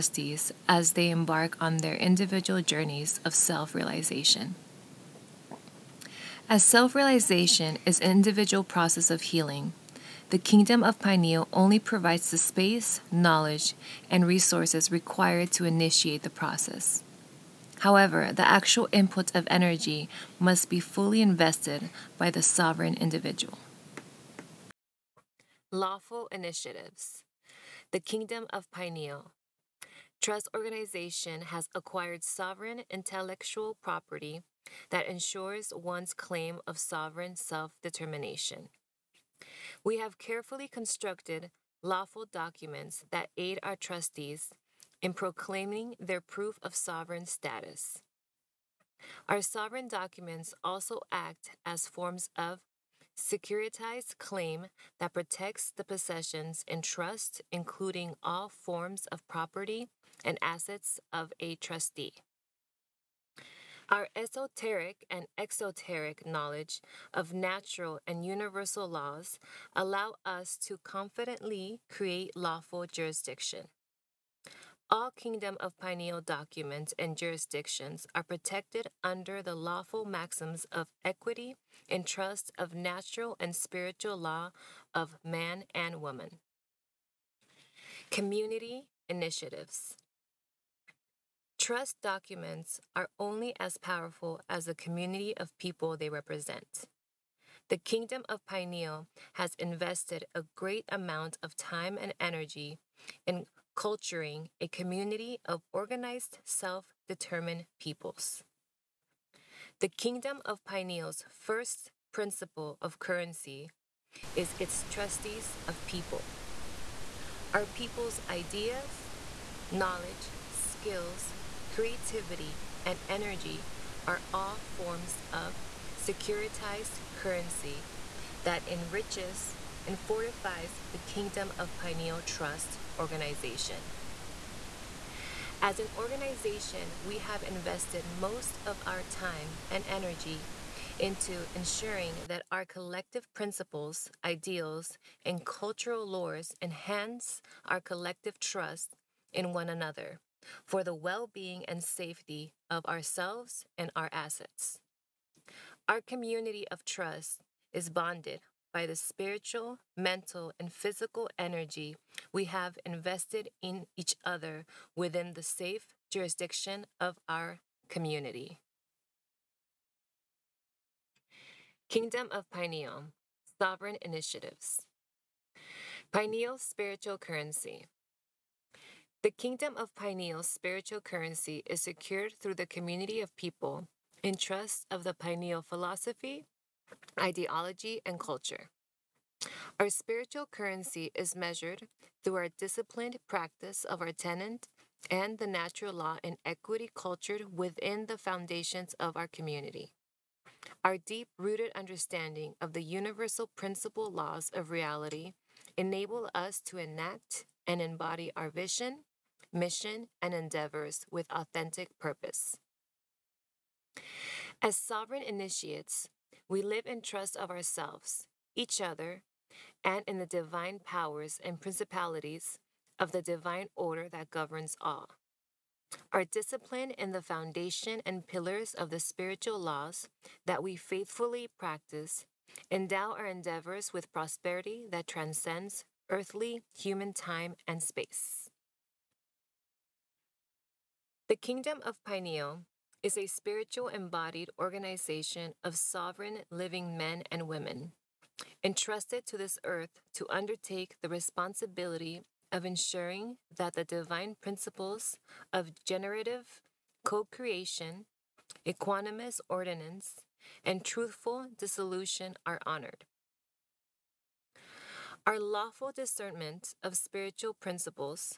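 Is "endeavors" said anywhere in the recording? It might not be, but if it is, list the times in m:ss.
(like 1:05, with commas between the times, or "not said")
3:30, 3:53.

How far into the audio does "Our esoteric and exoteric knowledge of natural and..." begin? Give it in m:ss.
1:03.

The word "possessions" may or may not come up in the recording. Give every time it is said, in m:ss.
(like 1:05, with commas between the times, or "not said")
0:55.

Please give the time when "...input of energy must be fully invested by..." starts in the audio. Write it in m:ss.
0:18.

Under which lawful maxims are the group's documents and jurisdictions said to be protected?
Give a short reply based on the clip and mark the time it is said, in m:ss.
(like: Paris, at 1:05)
equity and trust, at 1:21.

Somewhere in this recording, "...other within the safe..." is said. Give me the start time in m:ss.
2:44.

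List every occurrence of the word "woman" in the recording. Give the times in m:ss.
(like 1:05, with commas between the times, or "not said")
1:25.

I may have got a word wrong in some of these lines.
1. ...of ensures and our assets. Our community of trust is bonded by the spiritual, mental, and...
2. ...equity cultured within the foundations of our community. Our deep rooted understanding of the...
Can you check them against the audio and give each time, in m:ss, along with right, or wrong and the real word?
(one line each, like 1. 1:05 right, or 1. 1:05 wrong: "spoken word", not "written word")
1. 2:32 wrong: "ourselves", not "ensures"
2. 3:16 right.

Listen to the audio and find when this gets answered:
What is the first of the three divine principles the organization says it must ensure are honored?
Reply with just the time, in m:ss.
4:15.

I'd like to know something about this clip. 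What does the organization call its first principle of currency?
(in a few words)
its trustees of people.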